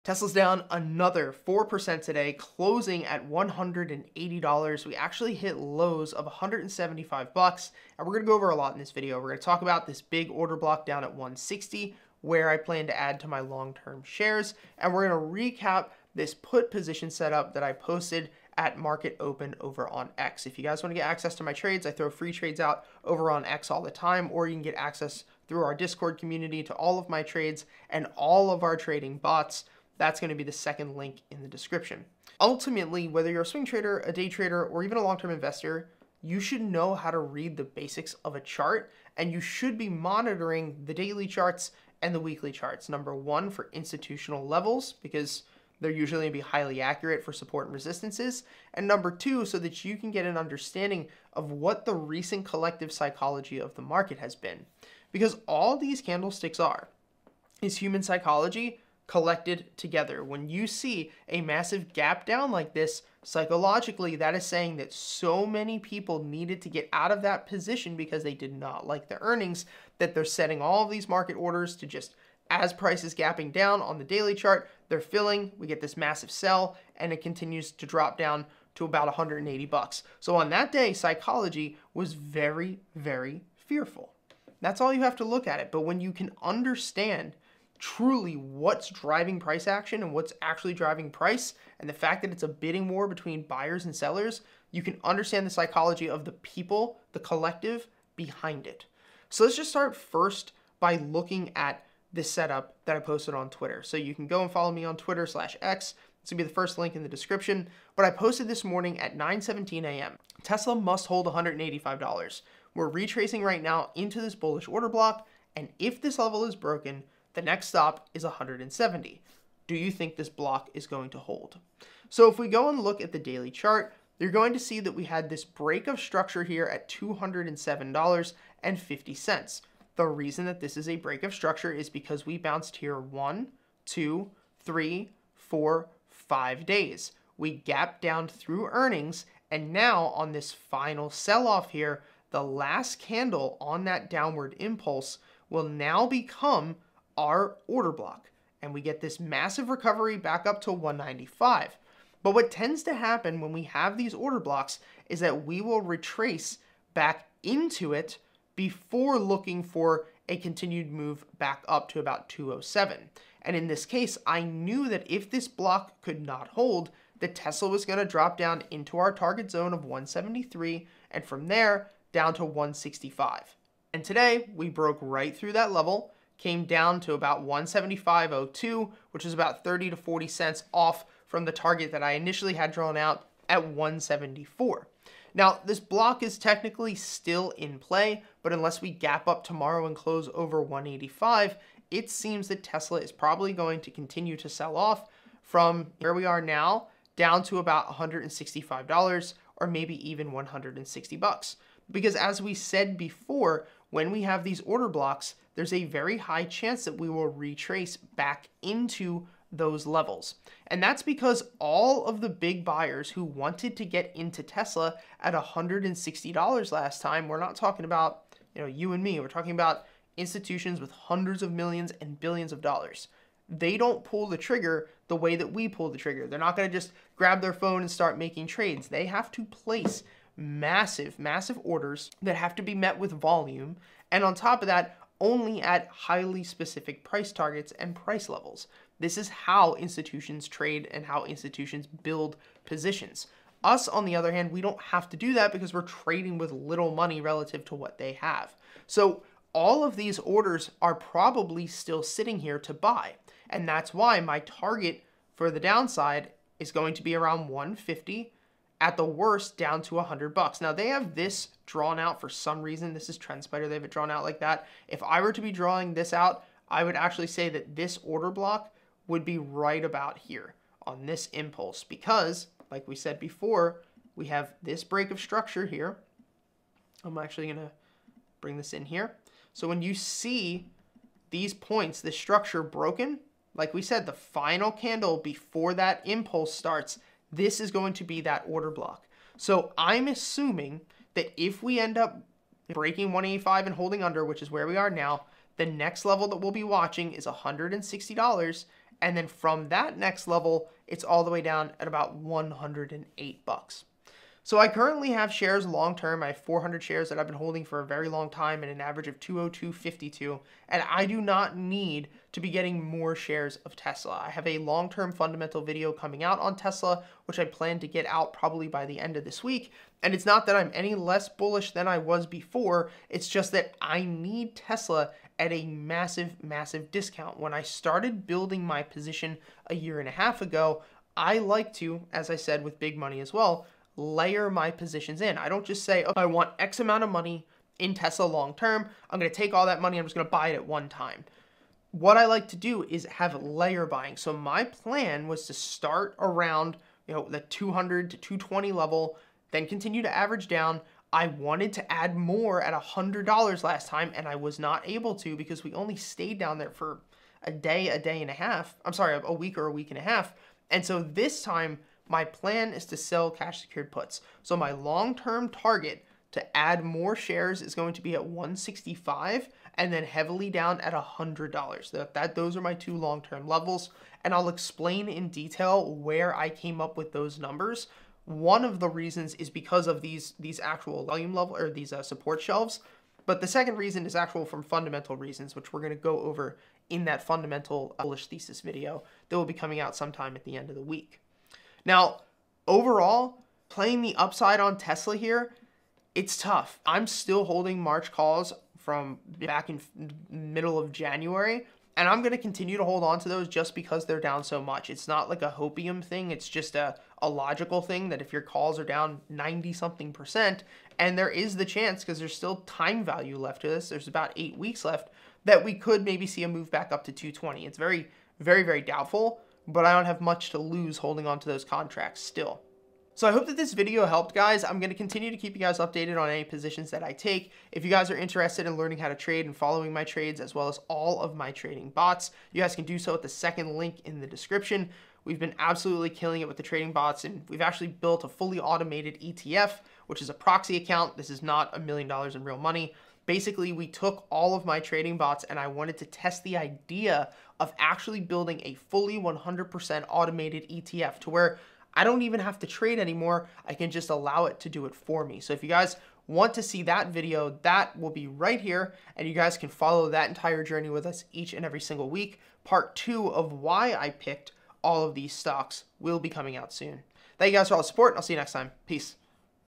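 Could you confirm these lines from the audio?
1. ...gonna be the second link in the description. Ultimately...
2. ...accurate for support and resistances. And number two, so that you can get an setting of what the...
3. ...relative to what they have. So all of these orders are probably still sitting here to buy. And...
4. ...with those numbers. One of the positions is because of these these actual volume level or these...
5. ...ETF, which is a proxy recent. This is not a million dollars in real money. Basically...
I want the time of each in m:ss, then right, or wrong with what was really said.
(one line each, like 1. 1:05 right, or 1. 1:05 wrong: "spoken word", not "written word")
1. 0:30 right
2. 0:46 wrong: "understanding", not "setting"
3. 4:07 right
4. 6:16 wrong: "reasons", not "positions"
5. 7:19 wrong: "account", not "recent".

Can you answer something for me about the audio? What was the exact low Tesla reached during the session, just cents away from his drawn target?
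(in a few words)
175.02.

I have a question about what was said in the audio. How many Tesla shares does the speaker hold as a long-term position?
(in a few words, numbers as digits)
400.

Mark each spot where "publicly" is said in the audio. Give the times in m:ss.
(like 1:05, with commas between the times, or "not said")
not said.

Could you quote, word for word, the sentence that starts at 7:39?
And you guys can follow that entire journey with us each and every single week.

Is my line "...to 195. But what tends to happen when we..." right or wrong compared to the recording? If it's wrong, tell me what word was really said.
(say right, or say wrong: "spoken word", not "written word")
right.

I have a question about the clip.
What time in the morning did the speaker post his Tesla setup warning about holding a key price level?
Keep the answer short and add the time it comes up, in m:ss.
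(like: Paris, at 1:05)
9:17 a.m., at 1:49.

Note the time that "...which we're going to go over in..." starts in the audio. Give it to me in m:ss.
6:25.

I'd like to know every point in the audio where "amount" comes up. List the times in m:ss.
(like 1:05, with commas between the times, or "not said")
5:36.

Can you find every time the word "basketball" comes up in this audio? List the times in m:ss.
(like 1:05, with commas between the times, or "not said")
not said.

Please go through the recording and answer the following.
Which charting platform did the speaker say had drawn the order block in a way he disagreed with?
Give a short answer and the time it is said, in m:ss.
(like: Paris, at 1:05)
TrendSpider, at 4:23.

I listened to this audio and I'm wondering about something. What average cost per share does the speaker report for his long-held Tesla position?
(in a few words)
$202.52.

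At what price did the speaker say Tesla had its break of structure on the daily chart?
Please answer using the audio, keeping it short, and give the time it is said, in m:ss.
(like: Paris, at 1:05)
$207.50, at 2:06.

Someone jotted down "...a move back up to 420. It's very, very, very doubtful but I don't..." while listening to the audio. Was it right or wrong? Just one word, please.
wrong.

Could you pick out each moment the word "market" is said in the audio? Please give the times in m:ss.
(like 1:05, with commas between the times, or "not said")
0:18, 0:53, 1:11.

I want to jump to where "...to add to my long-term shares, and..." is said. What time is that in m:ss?
0:12.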